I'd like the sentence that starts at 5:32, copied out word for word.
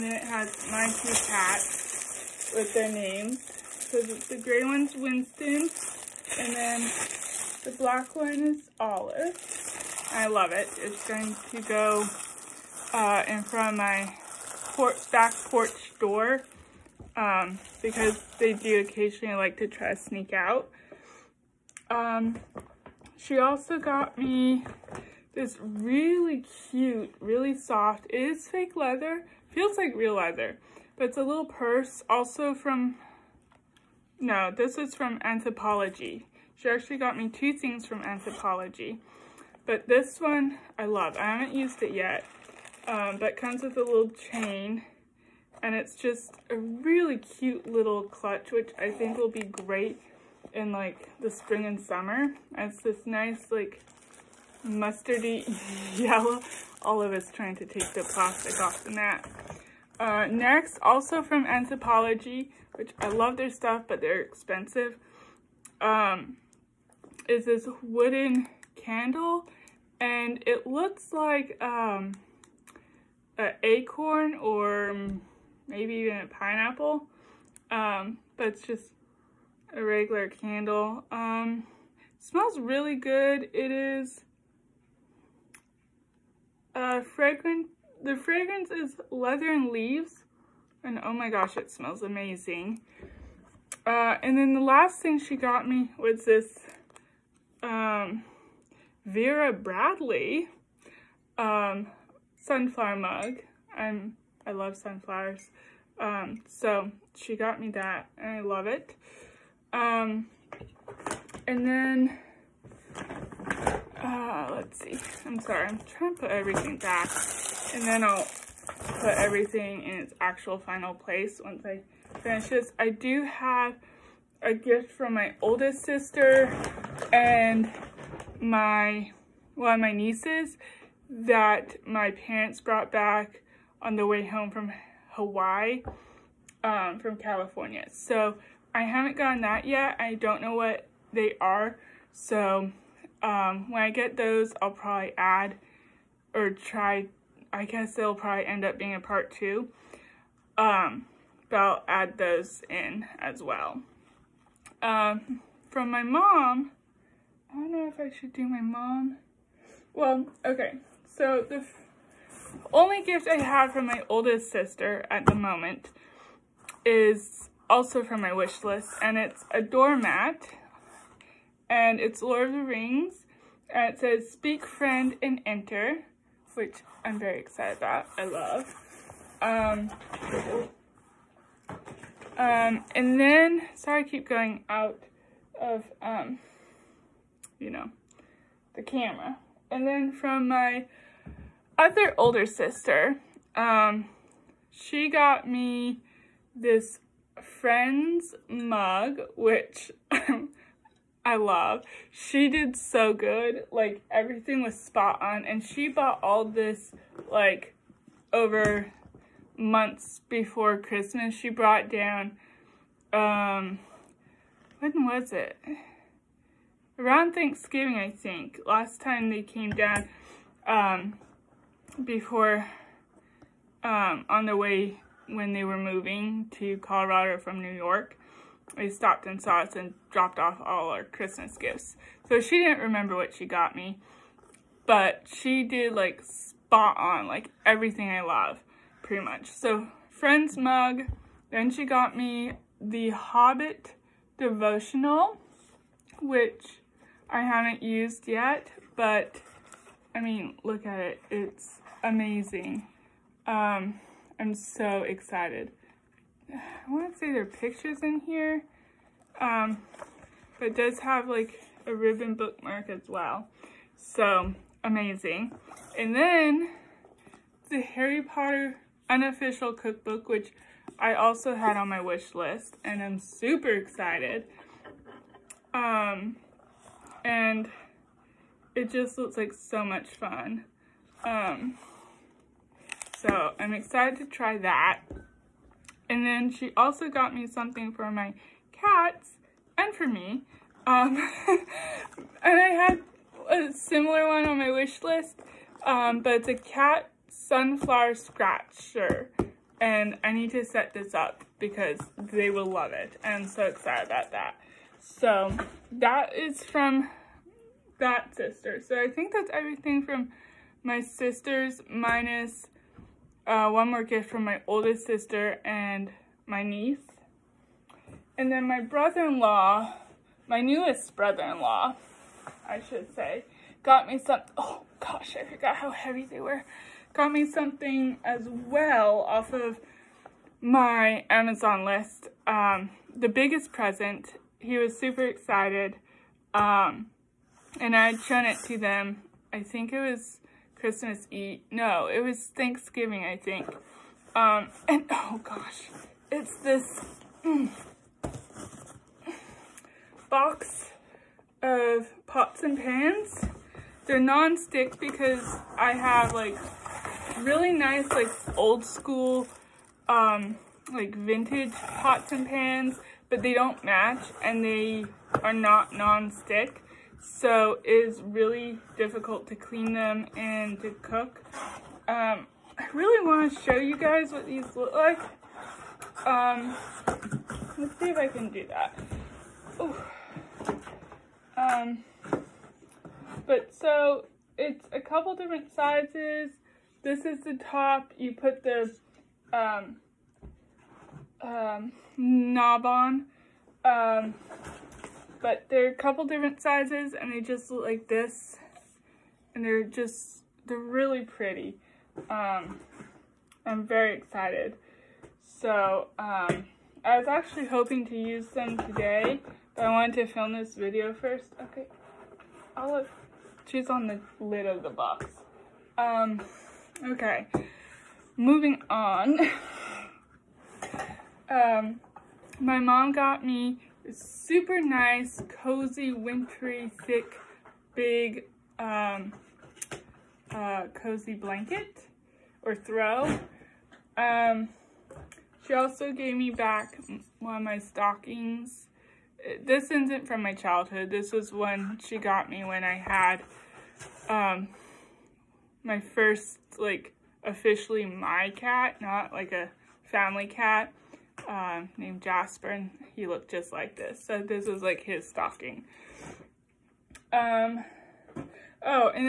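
Um, the biggest present, he was super excited.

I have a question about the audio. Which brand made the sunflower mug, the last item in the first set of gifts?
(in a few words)
Vera Bradley.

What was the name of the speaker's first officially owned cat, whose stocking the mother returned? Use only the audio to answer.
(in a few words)
Jasper.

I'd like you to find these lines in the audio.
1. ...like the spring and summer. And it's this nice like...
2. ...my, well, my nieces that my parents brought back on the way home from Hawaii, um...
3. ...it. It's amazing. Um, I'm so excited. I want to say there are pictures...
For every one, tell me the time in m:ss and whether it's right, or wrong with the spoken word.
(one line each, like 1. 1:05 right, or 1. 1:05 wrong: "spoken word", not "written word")
1. 0:50 right
2. 2:08 right
3. 4:10 right.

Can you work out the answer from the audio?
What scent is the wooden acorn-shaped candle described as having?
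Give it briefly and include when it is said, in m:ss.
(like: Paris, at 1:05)
leather and leaves, at 1:29.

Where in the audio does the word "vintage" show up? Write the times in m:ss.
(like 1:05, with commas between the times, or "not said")
6:01.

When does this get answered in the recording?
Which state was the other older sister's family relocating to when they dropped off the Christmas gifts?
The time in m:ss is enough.
3:46.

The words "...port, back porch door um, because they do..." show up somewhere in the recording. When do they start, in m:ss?
0:14.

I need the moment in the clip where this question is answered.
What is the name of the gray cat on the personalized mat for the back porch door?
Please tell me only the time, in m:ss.
0:04.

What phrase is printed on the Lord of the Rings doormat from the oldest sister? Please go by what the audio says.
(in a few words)
Speak Friend and Enter.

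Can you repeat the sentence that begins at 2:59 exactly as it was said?
Um, um, and then, sorry I keep going out of, um, you know, the camera.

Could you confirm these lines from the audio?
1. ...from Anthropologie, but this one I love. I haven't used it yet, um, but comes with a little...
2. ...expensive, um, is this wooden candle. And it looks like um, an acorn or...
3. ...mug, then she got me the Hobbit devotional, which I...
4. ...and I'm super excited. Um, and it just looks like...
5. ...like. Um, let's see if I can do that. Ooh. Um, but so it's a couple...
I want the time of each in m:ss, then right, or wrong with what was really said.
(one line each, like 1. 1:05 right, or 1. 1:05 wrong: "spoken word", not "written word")
1. 0:37 right
2. 1:04 right
3. 4:00 right
4. 4:32 right
5. 6:14 right.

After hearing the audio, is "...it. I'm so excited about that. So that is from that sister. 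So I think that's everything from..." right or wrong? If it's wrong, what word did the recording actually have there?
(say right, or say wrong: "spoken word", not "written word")
right.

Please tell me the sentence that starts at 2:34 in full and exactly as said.
Um, from my mom, I don't know if I should do my mom.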